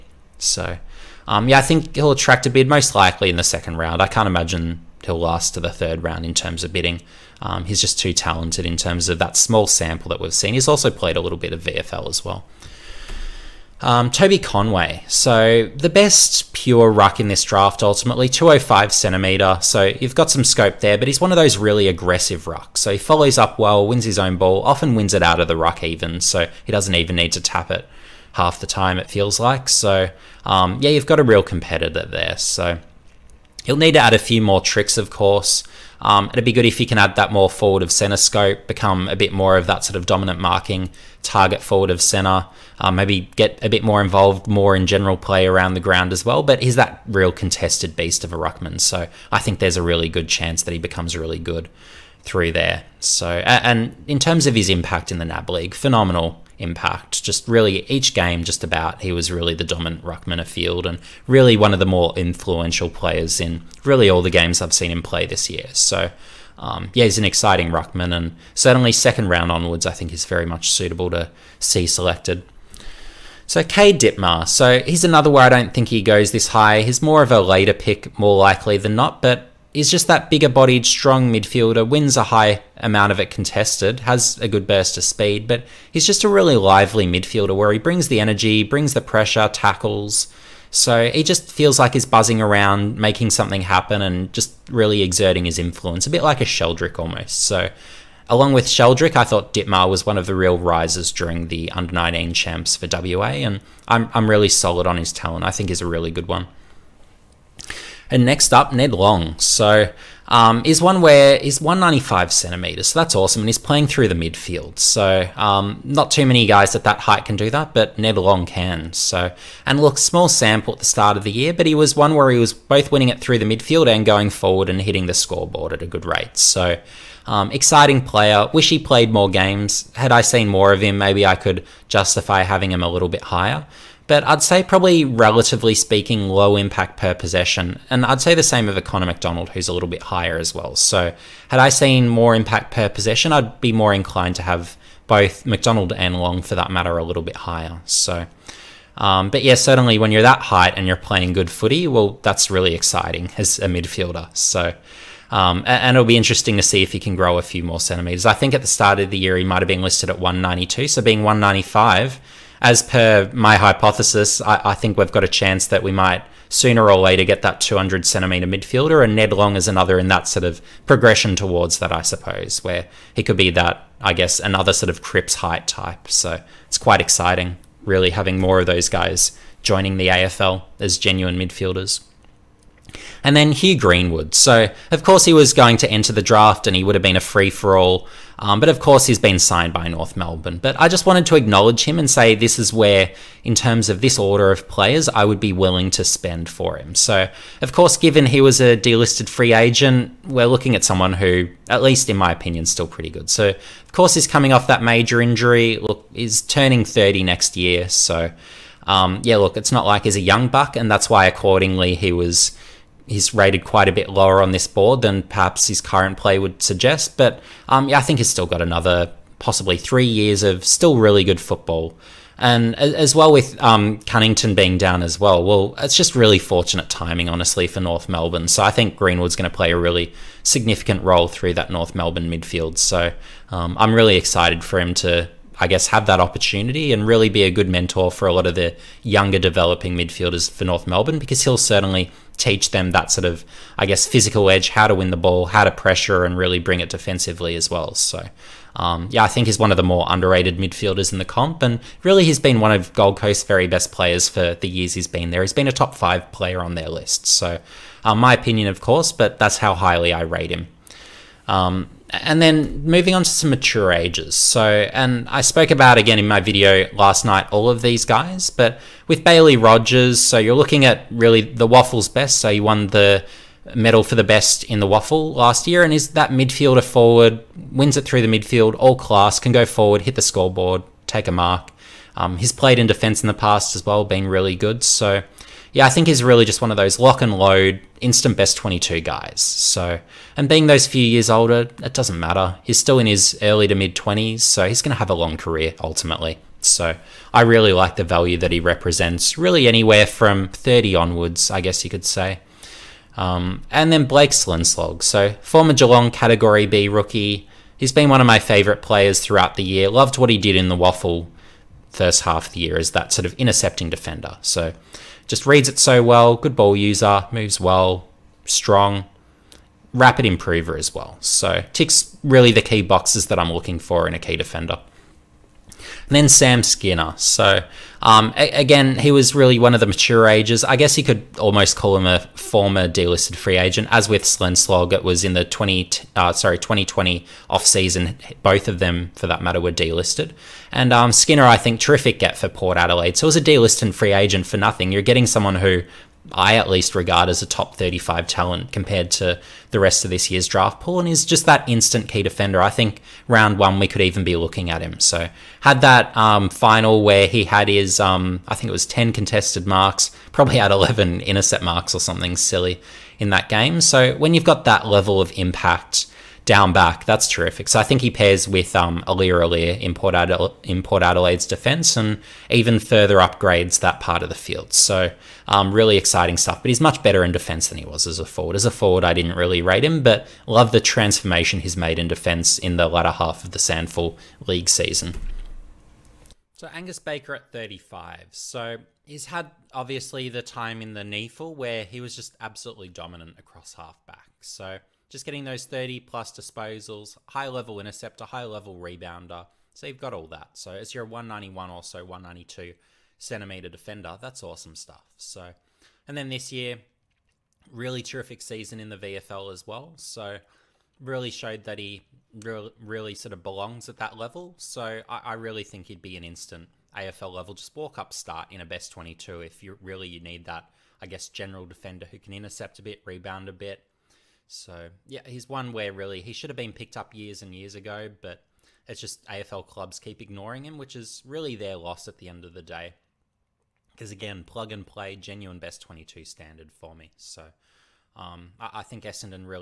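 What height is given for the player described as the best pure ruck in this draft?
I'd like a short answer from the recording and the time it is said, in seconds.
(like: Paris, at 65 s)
205 centimetres, at 18 s.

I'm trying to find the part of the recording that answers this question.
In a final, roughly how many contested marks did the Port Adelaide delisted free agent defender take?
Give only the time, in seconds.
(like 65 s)
358 s.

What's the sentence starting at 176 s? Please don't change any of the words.
So it's quite exciting, really, having more of those guys joining the AFL as genuine midfielders.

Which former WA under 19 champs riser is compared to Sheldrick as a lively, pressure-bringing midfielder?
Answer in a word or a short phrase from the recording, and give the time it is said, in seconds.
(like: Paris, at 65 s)
Ditmar, at 99 s.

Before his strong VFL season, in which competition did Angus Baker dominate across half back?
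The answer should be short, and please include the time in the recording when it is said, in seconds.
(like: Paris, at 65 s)
NEAFL, at 391 s.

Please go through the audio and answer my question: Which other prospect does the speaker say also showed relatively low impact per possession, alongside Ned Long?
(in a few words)
Connor McDonald.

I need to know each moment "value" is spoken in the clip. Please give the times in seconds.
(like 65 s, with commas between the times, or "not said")
298 s.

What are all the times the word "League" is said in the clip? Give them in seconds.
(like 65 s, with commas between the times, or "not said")
55 s, 384 s.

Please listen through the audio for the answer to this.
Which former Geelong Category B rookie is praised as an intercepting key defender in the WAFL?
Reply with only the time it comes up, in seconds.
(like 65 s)
304 s.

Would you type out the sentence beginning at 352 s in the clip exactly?
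I think round one, we could even be looking at him.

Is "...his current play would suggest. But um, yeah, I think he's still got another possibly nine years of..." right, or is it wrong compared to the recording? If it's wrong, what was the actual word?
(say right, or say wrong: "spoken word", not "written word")
wrong: "three", not "nine".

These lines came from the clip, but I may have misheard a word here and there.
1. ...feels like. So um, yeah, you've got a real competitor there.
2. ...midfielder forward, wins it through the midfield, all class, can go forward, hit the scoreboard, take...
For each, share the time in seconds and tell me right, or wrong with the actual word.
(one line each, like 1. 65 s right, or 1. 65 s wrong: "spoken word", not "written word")
1. 29 s right
2. 276 s right.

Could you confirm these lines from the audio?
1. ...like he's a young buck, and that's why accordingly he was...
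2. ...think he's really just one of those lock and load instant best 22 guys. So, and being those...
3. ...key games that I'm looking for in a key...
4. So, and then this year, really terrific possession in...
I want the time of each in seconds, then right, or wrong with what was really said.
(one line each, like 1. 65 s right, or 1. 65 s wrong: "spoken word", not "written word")
1. 209 s right
2. 285 s right
3. 322 s wrong: "boxes", not "games"
4. 405 s wrong: "season", not "possession".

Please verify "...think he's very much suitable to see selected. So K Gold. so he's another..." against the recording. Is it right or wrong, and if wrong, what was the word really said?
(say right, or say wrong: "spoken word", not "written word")
wrong: "Dipmar", not "Gold".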